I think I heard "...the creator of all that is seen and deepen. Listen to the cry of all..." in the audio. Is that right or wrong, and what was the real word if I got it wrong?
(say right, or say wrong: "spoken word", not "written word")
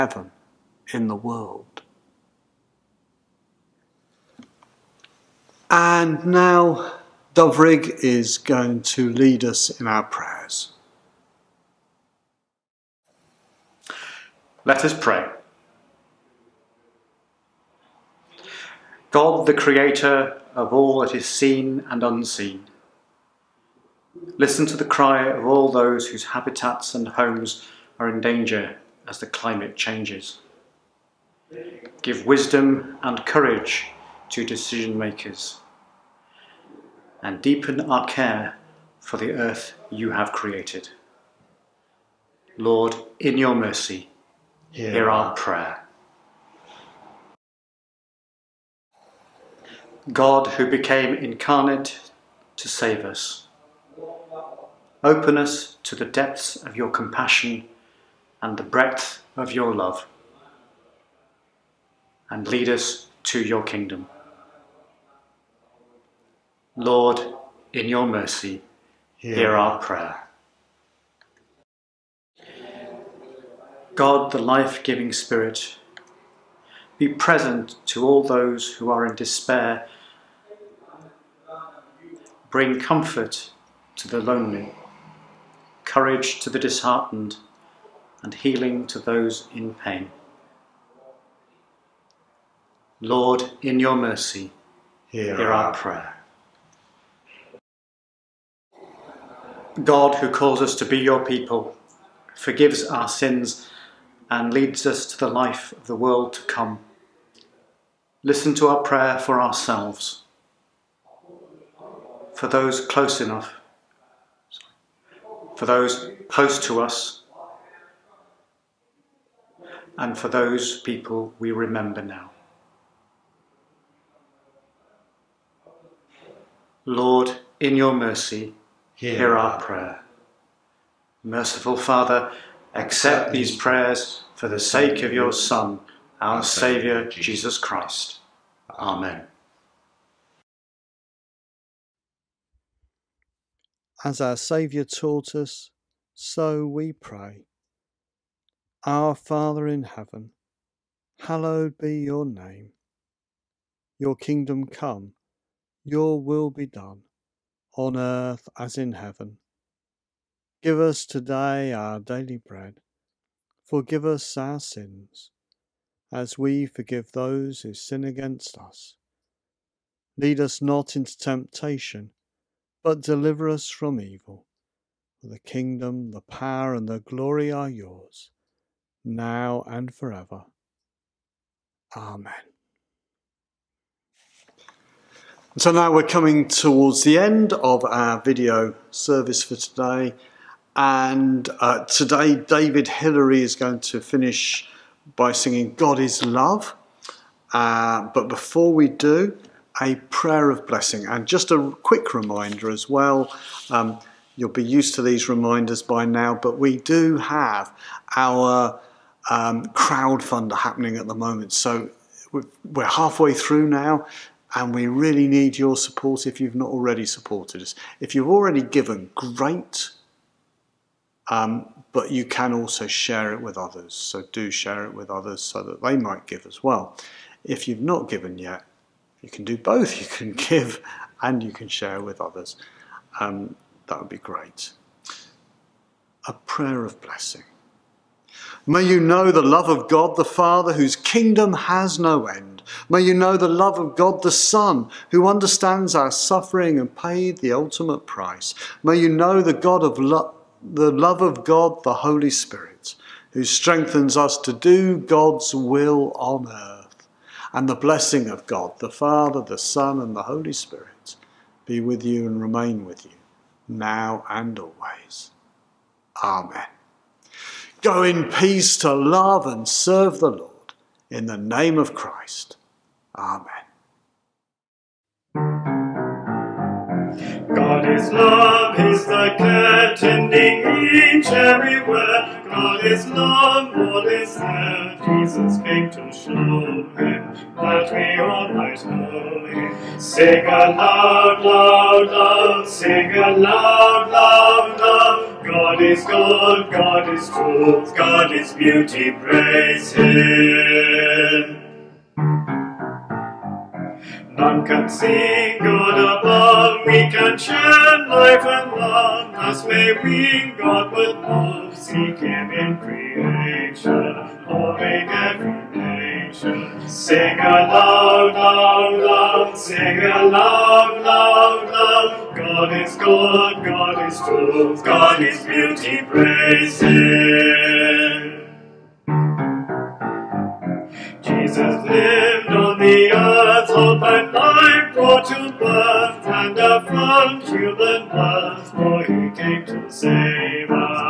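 wrong: "unseen", not "deepen".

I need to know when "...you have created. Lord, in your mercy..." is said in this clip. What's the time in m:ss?
0:39.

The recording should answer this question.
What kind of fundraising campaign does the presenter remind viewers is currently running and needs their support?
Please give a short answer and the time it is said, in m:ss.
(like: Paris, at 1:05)
crowdfunder, at 3:29.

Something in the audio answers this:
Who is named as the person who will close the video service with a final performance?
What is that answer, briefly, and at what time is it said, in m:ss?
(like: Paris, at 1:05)
David Hillary, at 3:12.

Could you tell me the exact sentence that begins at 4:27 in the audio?
Go in peace to love and serve the Lord in the name of Christ.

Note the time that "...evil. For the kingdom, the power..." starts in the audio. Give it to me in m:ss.
2:53.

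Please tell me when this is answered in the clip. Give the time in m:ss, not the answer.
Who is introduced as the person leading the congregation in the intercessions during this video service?
0:07.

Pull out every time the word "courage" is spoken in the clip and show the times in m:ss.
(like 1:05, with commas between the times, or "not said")
0:33, 1:25.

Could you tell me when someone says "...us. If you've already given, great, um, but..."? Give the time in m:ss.
3:37.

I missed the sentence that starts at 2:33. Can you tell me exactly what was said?
Your kingdom come, your will be done, on earth as in heaven.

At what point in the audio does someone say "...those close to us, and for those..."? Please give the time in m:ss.
1:55.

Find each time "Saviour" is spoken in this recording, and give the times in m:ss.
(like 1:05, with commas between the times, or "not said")
2:16, 2:24.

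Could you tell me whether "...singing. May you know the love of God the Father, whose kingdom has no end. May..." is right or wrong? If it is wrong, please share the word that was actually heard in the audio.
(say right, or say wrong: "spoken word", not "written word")
wrong: "blessing", not "singing".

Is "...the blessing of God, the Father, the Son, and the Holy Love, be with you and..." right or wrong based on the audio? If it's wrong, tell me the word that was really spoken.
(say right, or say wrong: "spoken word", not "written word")
wrong: "Spirit", not "Love".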